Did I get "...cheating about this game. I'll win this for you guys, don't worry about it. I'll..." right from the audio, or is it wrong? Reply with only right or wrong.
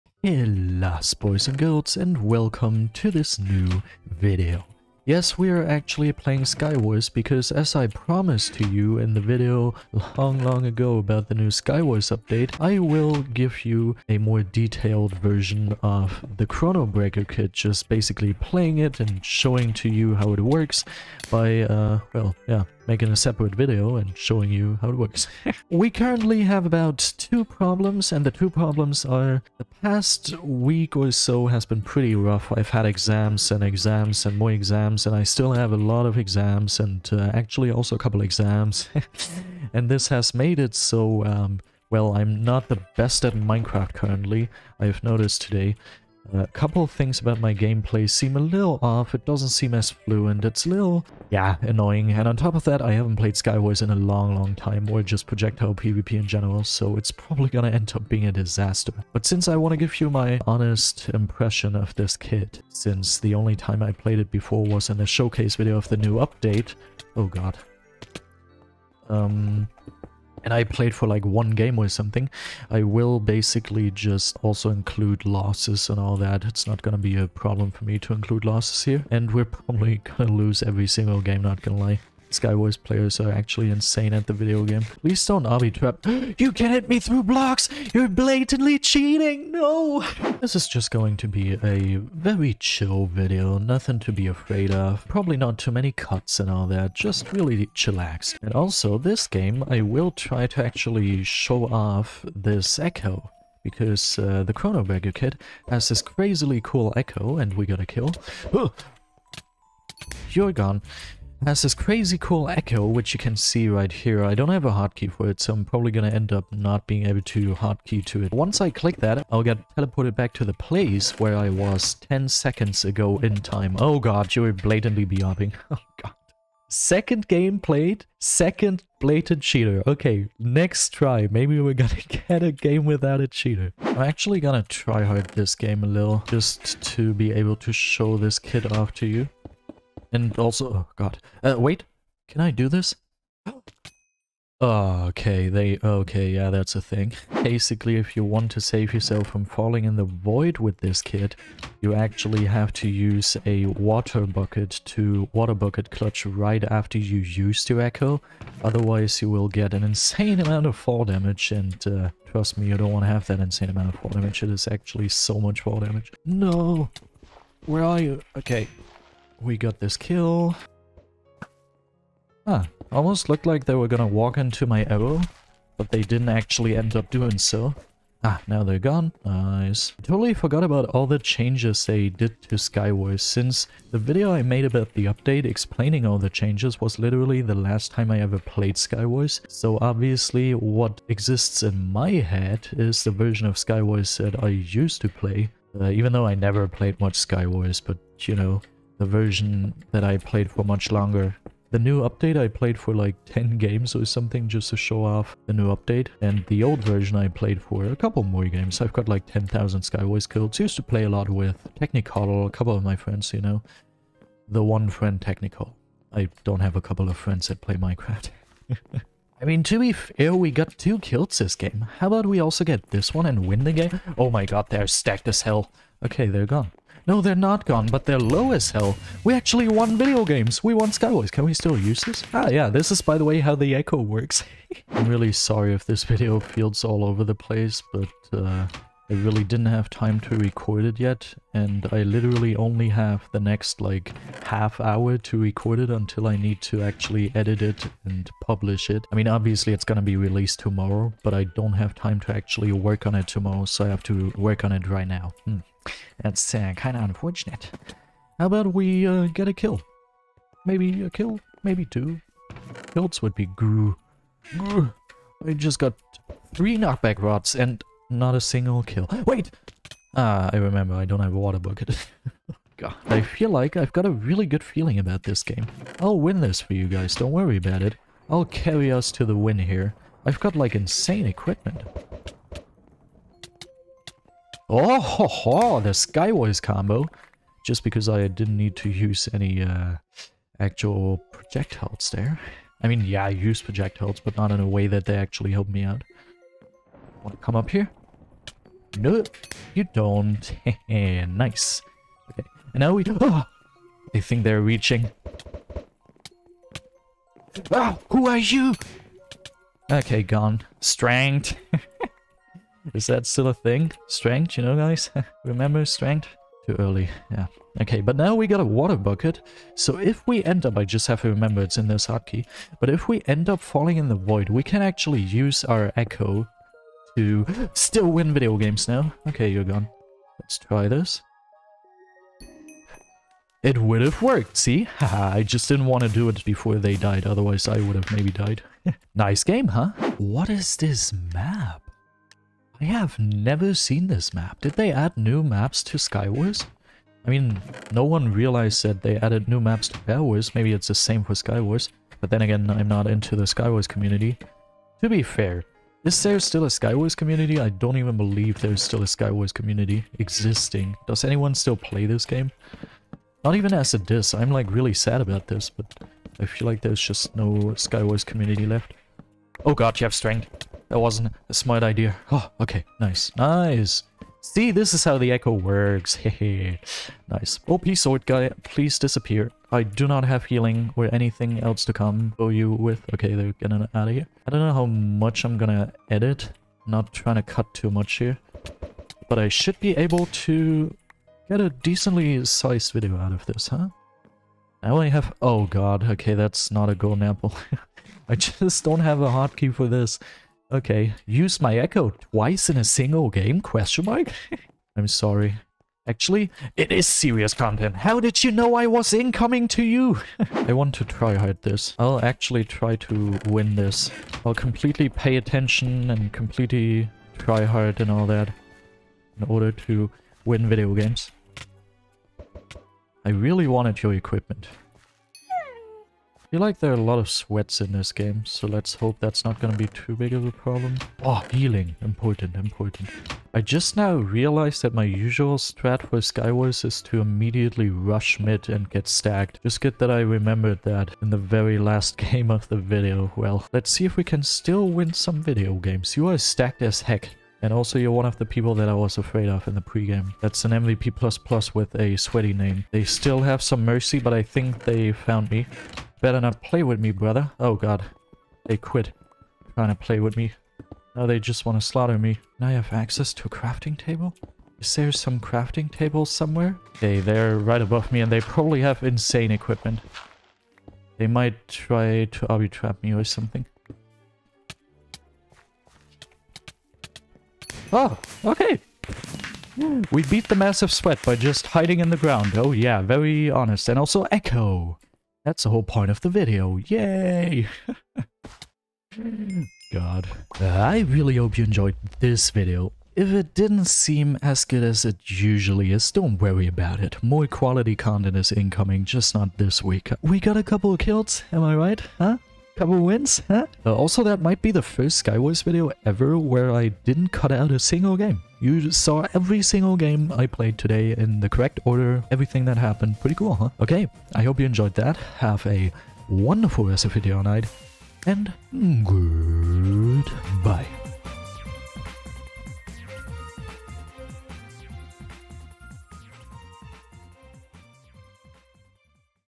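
wrong.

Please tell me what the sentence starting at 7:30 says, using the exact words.
That's an MVP++ with a sweaty name.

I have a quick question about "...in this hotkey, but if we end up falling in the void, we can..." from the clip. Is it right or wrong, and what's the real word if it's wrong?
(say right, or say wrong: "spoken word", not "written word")
right.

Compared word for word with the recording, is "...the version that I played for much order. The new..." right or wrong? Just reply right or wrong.
wrong.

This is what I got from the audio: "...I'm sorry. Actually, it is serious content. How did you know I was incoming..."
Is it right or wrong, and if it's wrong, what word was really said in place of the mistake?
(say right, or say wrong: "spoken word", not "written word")
right.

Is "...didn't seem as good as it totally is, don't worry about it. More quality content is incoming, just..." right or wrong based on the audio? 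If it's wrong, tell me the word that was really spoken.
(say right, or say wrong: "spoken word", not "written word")
wrong: "usually", not "totally".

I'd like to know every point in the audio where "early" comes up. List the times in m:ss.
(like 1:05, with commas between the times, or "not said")
5:16.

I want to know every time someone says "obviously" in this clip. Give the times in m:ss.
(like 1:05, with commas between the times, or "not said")
3:09, 4:09.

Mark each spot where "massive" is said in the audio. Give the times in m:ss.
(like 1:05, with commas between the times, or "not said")
8:00.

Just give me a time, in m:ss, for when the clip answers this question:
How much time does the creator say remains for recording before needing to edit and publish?
4:04.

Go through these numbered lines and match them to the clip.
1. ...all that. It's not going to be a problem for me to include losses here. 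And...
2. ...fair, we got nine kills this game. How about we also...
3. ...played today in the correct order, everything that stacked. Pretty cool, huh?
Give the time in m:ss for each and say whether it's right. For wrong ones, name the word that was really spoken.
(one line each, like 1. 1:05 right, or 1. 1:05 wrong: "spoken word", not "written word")
1. 1:15 right
2. 3:39 wrong: "two", not "nine"
3. 8:30 wrong: "happened", not "stacked".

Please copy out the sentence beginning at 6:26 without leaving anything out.
not trying to cut too much here.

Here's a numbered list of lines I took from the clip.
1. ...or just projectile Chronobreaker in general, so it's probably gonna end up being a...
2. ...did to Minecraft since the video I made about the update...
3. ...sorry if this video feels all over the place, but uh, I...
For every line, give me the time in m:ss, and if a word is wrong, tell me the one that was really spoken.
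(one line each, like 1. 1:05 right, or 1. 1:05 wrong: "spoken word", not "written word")
1. 0:54 wrong: "PvP", not "Chronobreaker"
2. 3:02 wrong: "Skywars", not "Minecraft"
3. 3:55 right.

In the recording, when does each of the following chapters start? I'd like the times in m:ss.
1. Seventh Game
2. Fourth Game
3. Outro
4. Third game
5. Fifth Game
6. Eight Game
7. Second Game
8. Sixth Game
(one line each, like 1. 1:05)
1. 5:40
2. 2:28
3. 8:11
4. 2:14
5. 3:55
6. 6:50
7. 1:30
8. 4:33.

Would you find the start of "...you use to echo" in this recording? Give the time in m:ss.
2:36.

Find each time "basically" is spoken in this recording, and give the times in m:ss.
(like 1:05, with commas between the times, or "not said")
0:17, 1:13, 2:27.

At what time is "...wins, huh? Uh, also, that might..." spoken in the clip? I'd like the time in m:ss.
8:22.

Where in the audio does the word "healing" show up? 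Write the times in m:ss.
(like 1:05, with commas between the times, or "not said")
6:20, 7:11.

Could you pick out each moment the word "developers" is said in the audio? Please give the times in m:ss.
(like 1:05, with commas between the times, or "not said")
not said.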